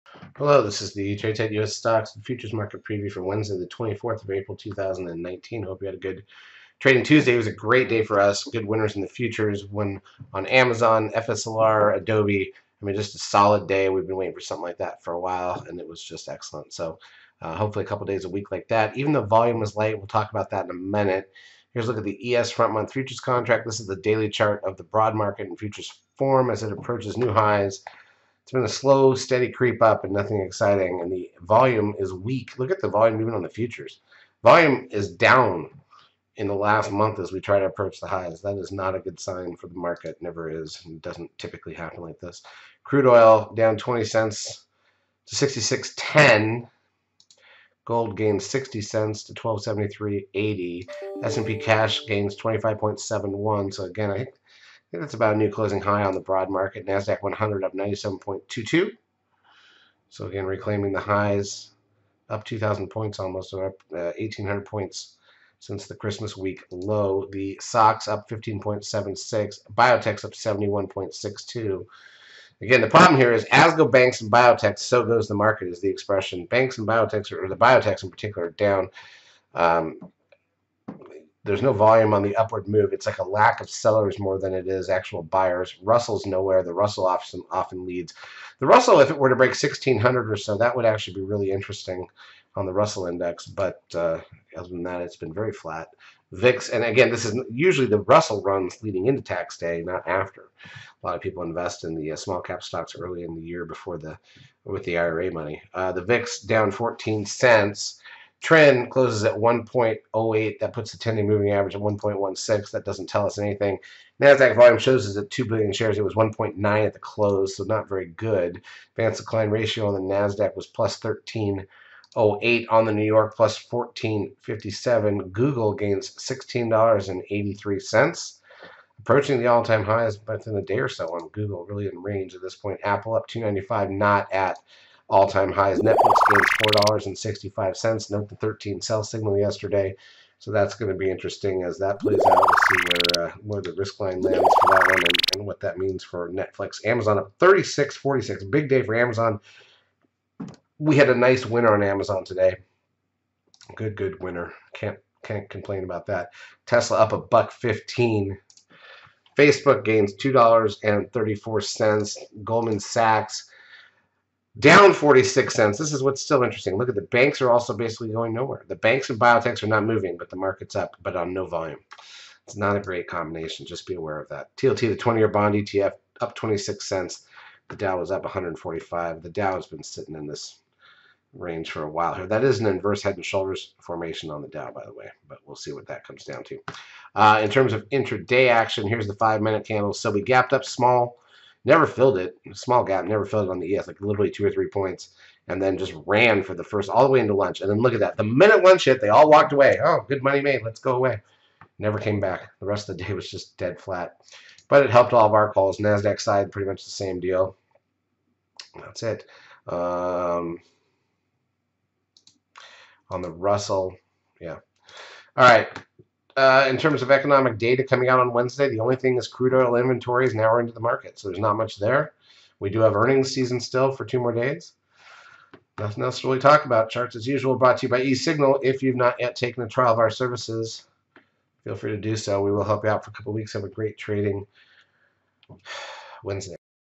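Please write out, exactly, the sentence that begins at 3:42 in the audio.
We do have earnings season still for two more days.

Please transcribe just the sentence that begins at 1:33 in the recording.
But uh, other than that, it's been very flat.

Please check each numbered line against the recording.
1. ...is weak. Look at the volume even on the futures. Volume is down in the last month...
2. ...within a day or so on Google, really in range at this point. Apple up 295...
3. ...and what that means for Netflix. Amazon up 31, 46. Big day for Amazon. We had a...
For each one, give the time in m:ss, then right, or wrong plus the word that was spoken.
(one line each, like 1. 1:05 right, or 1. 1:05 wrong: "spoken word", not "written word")
1. 0:31 right
2. 2:10 right
3. 2:25 wrong: "36", not "31".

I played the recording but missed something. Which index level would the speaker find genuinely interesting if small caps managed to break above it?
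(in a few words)
1600.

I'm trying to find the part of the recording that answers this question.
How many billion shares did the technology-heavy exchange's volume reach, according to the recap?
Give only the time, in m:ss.
1:55.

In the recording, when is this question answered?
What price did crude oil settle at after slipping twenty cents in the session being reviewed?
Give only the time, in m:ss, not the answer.
0:45.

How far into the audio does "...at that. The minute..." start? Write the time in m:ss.
3:17.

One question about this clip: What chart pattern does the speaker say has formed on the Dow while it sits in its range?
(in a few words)
inverse head and shoulders.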